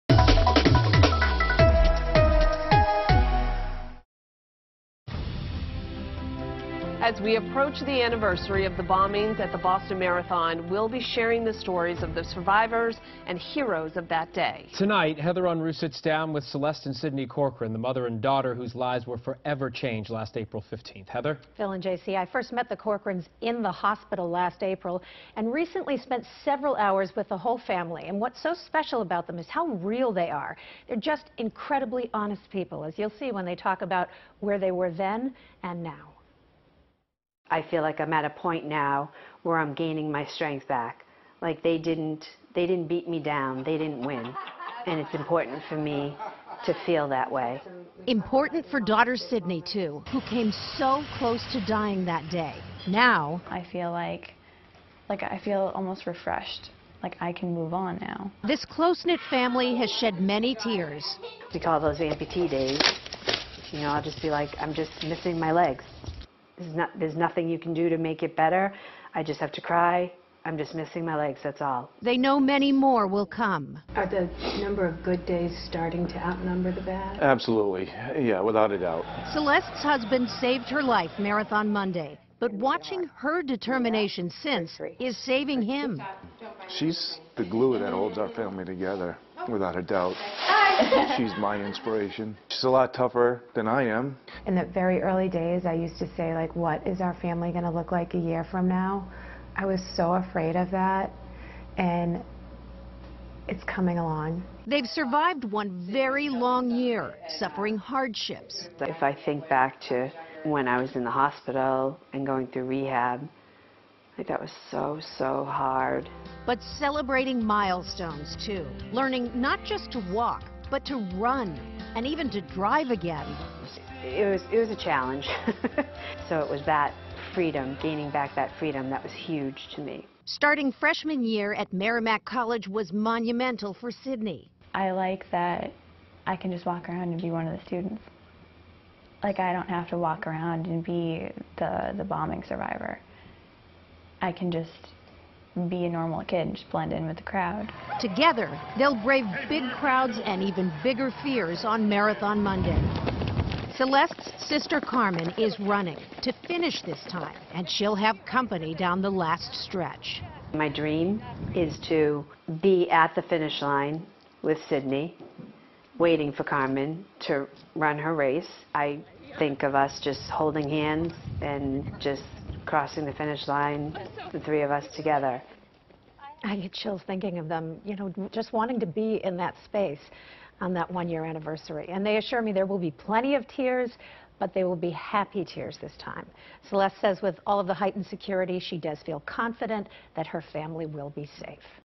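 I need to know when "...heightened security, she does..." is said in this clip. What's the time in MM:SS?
03:07.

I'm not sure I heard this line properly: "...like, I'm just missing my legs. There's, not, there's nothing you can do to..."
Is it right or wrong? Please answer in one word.
right.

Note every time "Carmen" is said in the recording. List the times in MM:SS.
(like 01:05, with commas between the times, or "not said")
02:34, 02:46.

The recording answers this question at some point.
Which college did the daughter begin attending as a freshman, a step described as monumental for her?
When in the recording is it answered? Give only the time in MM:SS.
02:11.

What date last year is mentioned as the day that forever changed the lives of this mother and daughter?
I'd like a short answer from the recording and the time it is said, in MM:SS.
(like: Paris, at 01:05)
April 15th, at 00:20.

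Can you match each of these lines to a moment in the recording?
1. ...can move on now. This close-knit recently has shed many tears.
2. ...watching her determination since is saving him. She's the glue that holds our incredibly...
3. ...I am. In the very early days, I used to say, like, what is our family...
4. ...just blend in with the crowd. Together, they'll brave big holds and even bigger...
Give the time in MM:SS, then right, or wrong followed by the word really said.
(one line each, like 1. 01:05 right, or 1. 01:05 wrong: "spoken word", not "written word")
1. 00:57 wrong: "family", not "recently"
2. 01:22 wrong: "family", not "incredibly"
3. 01:33 right
4. 02:26 wrong: "crowds", not "holds".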